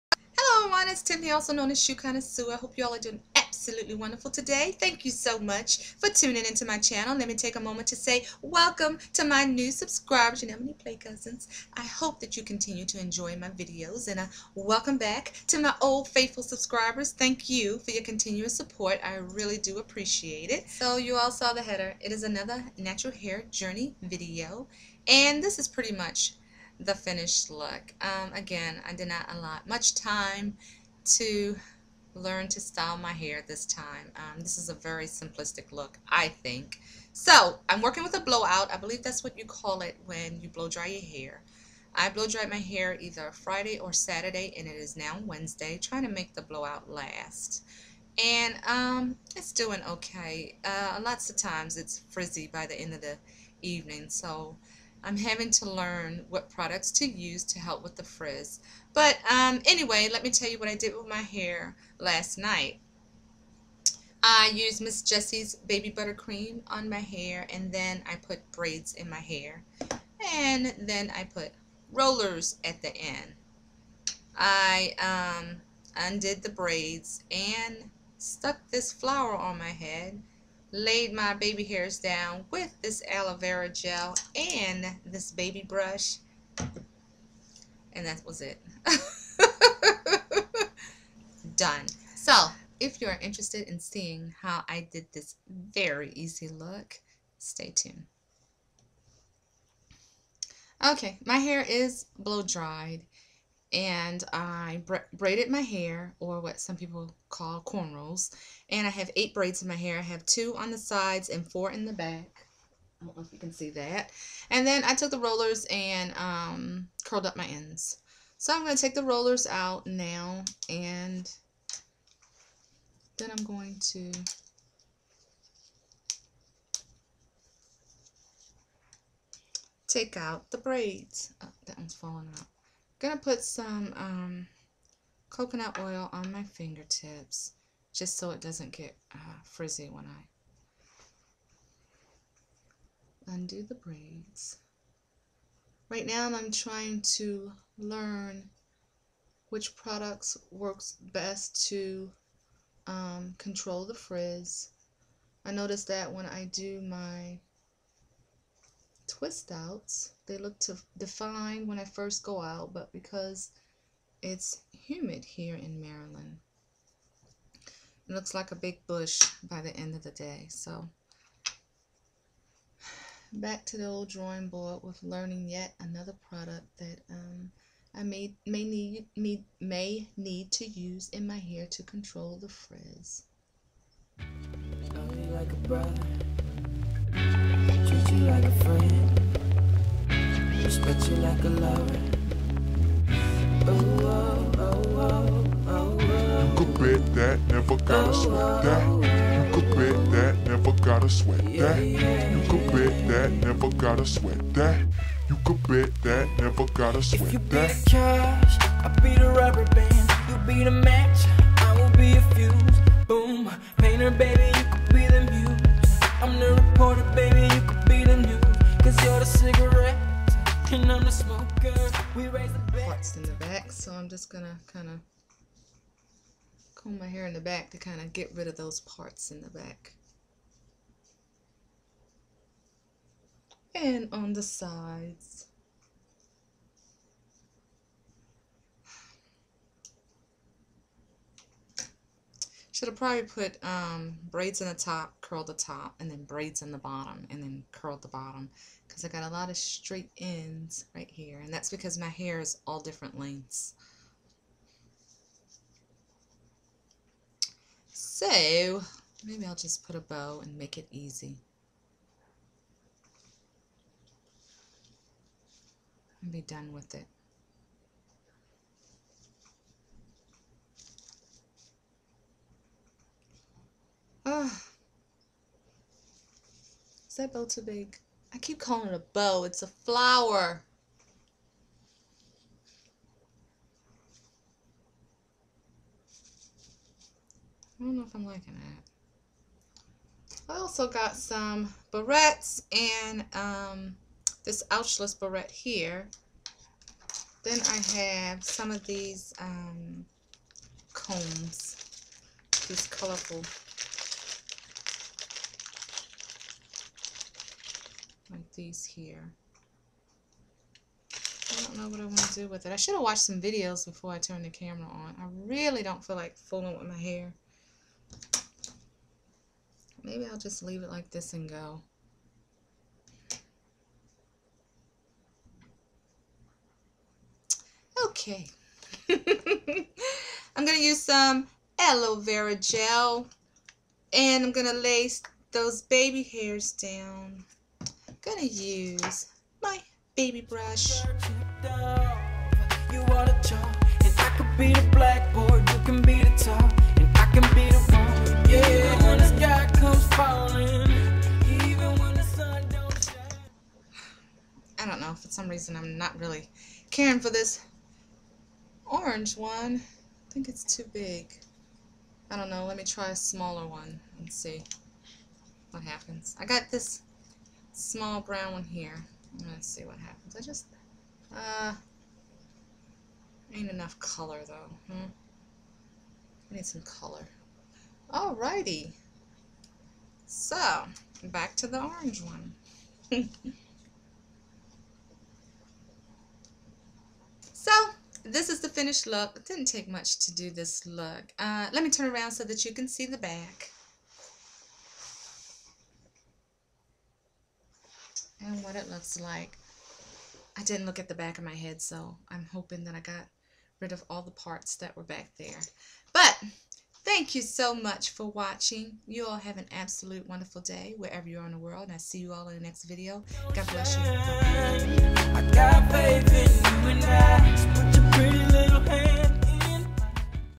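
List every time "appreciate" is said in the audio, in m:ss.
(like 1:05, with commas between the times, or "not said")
0:19.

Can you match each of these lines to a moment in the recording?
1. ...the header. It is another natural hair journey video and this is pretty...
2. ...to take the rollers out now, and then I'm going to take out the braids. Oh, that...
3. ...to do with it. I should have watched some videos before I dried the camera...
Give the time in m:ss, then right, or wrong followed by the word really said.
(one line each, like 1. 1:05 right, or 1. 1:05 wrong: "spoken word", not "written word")
1. 0:21 right
2. 1:58 right
3. 5:12 wrong: "turned", not "dried".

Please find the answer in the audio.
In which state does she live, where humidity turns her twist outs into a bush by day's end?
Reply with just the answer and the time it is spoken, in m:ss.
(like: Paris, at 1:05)
Maryland, at 2:45.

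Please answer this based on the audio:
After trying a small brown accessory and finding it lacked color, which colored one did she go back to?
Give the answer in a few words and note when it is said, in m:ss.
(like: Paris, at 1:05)
orange, at 6:21.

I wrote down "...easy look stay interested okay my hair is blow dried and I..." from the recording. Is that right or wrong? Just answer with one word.
wrong.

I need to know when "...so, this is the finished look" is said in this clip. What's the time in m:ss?
6:27.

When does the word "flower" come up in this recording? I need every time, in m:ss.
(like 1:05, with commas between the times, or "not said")
1:18, 4:39.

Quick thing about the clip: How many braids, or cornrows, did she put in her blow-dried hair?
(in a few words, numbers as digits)
8.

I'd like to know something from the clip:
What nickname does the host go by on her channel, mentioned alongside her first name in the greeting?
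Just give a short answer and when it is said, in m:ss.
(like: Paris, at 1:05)
Shoe Connoisseur, at 0:01.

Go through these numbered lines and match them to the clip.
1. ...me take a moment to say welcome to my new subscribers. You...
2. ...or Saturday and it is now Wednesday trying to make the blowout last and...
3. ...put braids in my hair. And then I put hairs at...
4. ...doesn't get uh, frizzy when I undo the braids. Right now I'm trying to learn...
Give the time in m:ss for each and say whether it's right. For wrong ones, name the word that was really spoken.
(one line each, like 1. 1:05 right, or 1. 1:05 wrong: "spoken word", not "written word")
1. 0:07 right
2. 0:43 right
3. 1:08 wrong: "rollers", not "hairs"
4. 2:18 right.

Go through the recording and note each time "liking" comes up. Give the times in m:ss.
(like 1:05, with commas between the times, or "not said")
4:48.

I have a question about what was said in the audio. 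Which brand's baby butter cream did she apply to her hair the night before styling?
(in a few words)
Miss Jessie's.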